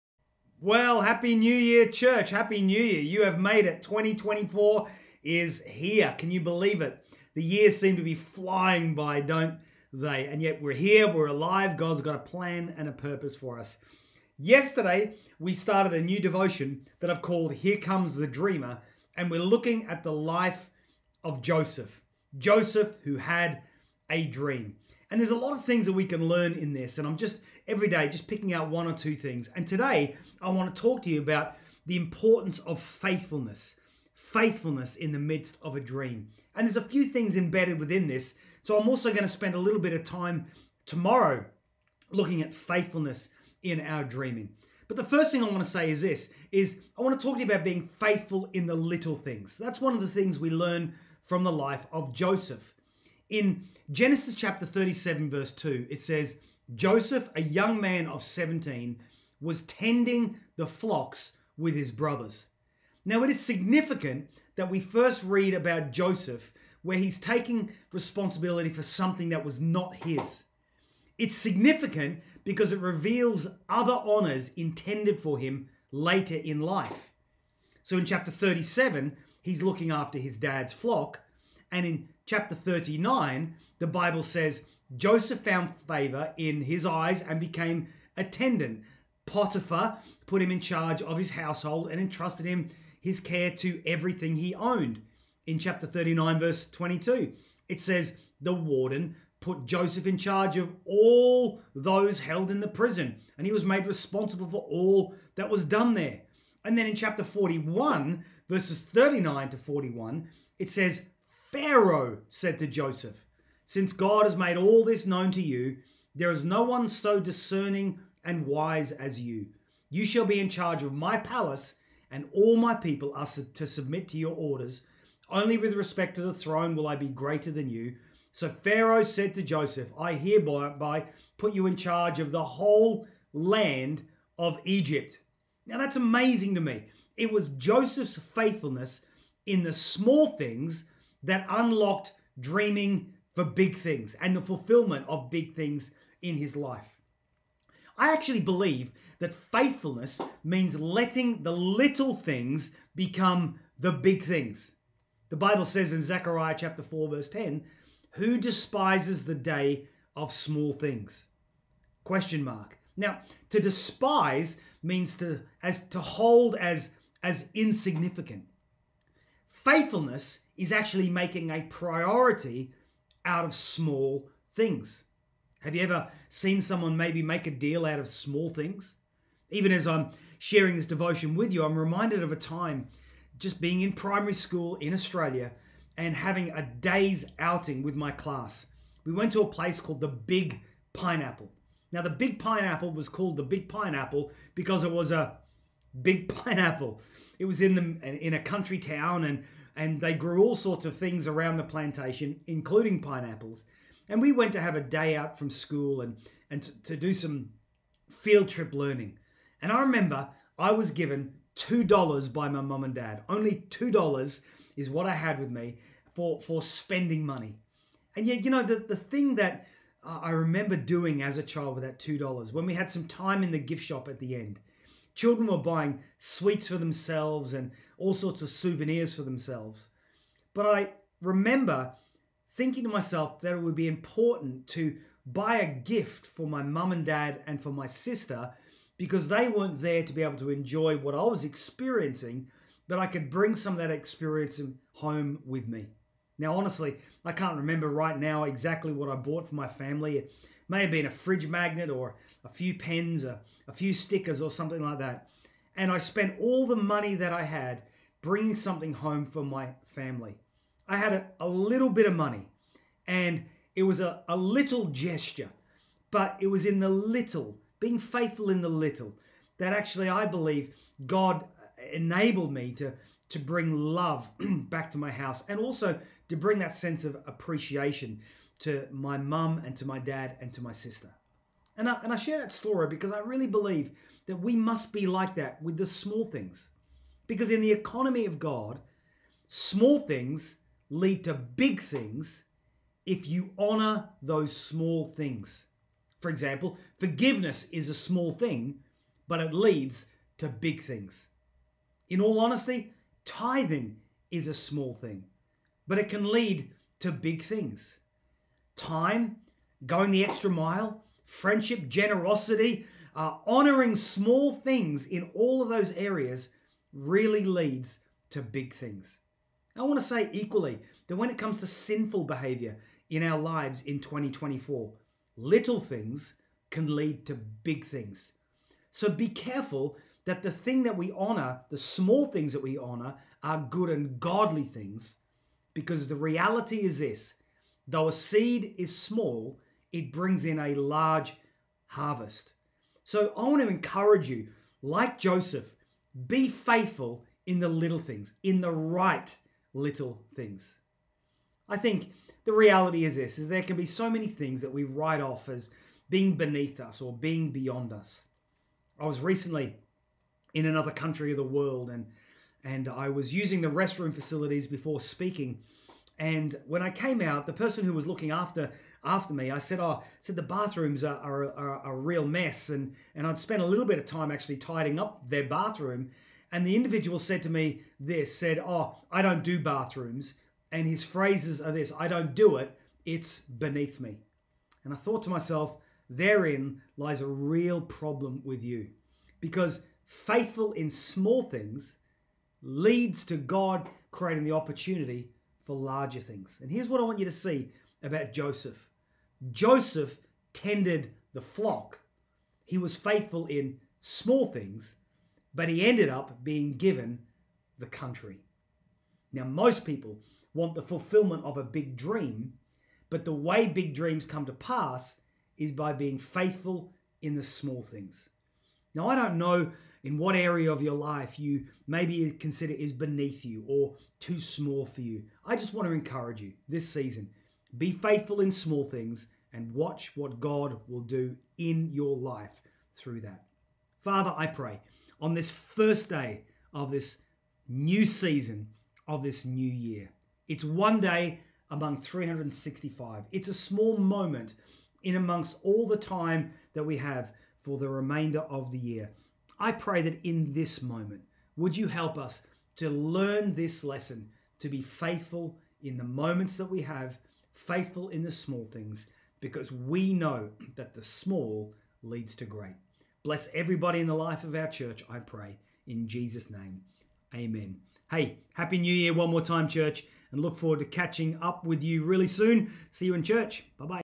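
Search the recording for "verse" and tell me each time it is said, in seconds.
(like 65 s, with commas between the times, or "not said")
55 s, 96 s, 108 s, 157 s.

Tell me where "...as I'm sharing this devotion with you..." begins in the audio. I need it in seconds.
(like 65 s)
179 s.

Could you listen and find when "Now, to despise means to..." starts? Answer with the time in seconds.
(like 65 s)
162 s.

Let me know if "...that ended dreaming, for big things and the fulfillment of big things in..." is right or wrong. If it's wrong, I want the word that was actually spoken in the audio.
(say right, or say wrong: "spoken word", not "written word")
wrong: "unlocked", not "ended".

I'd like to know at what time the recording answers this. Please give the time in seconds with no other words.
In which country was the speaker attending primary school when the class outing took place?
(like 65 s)
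184 s.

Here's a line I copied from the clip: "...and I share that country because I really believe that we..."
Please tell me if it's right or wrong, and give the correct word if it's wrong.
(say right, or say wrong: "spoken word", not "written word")
wrong: "story", not "country".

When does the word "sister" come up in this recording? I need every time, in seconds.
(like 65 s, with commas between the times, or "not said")
237 s, 280 s.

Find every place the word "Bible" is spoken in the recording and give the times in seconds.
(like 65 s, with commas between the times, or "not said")
83 s, 155 s.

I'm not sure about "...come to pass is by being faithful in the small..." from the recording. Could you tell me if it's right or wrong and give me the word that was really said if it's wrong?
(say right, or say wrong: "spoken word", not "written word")
right.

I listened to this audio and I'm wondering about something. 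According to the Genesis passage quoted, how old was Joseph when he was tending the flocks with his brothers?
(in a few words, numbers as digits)
17.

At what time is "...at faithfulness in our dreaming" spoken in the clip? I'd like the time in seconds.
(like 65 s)
42 s.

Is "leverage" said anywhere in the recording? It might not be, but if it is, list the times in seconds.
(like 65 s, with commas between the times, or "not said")
not said.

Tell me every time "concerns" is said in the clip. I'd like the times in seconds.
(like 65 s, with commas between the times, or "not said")
not said.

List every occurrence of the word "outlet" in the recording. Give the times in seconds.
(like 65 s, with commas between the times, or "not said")
not said.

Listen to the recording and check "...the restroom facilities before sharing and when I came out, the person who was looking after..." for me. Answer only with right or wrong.
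wrong.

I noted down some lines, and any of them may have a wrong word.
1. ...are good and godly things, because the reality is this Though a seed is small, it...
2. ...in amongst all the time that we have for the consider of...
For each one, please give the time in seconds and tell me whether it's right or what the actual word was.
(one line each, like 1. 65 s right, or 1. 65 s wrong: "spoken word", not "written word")
1. 333 s right
2. 445 s wrong: "remainder", not "consider".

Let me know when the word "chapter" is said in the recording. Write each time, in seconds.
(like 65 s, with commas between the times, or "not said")
54 s, 78 s, 82 s, 95 s, 106 s, 156 s.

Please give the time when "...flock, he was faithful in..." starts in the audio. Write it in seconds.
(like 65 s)
401 s.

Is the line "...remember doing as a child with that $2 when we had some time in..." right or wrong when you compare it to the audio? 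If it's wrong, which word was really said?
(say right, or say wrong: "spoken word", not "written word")
right.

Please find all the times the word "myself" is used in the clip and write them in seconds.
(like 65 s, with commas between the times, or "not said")
232 s, 385 s.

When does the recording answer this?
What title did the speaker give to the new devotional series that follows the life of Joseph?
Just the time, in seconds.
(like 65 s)
17 s.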